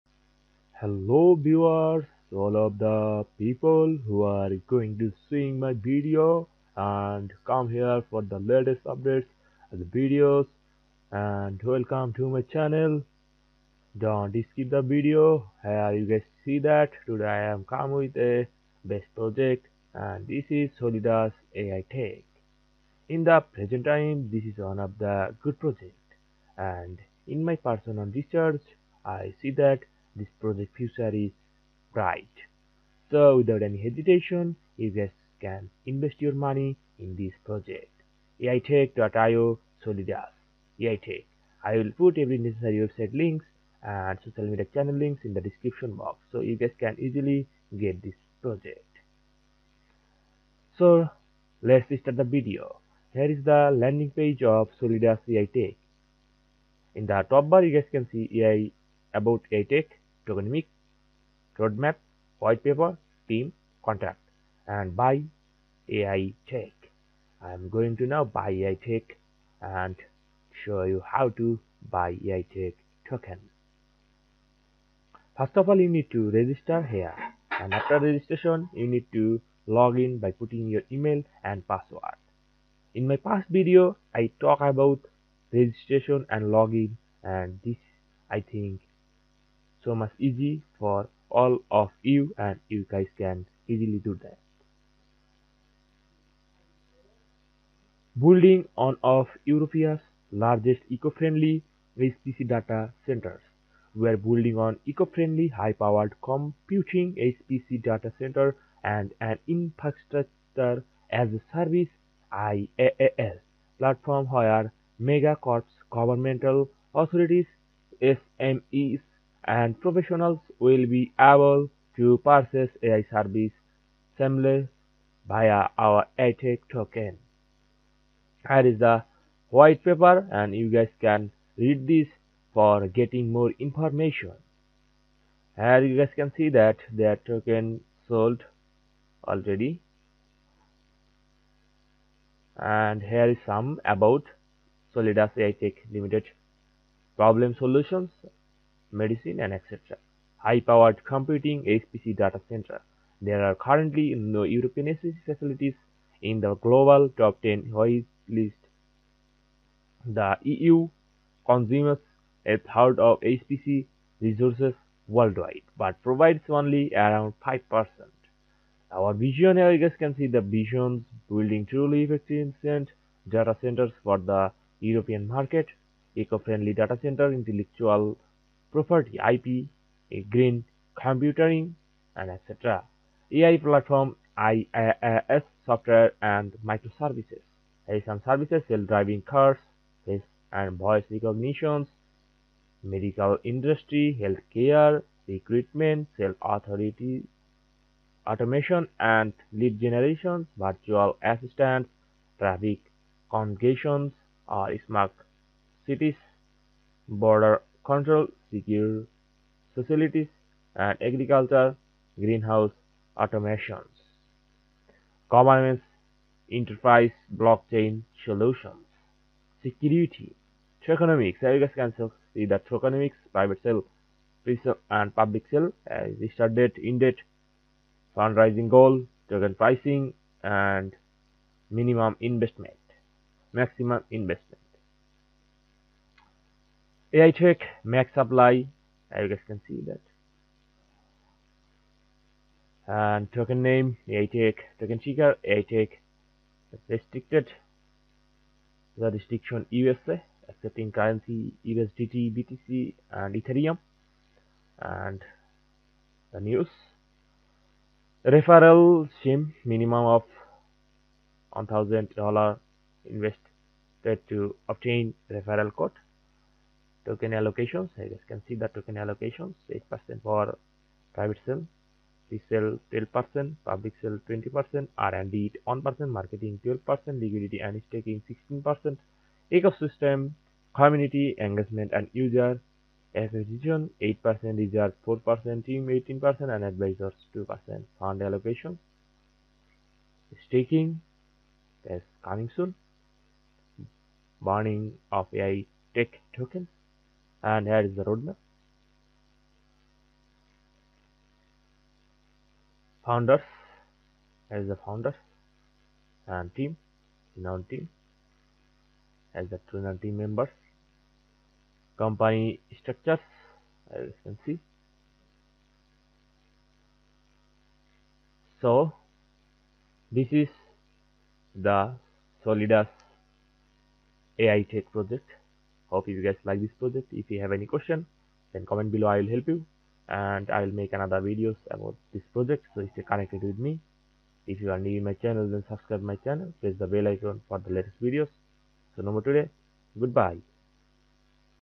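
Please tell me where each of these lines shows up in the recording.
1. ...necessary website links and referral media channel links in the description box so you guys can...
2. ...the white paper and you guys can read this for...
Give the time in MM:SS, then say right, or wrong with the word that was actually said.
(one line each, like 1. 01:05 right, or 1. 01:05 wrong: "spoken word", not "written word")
1. 00:42 wrong: "social", not "referral"
2. 02:08 right.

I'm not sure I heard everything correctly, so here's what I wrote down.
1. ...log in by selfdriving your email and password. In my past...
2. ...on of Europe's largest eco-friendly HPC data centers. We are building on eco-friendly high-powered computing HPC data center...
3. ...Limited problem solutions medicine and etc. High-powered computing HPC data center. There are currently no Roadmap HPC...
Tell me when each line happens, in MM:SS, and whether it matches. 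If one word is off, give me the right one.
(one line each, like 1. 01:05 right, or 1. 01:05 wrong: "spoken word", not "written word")
1. 01:19 wrong: "putting", not "selfdriving"
2. 01:38 right
3. 02:25 wrong: "European", not "Roadmap".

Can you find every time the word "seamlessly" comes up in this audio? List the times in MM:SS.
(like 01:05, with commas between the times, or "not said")
02:04.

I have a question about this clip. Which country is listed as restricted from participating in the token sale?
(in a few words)
USA.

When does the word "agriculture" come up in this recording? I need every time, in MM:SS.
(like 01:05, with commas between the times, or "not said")
03:31.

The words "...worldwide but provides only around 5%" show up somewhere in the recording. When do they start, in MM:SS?
02:45.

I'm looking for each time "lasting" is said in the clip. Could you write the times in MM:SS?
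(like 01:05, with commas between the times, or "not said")
not said.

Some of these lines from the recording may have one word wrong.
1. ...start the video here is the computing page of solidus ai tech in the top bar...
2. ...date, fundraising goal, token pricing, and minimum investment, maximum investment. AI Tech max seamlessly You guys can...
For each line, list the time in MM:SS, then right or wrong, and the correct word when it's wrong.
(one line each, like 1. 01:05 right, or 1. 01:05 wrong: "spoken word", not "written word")
1. 00:52 wrong: "landing", not "computing"
2. 03:46 wrong: "supply", not "seamlessly".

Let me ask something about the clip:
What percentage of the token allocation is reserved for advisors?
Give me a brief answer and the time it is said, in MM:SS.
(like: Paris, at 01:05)
2%, at 04:46.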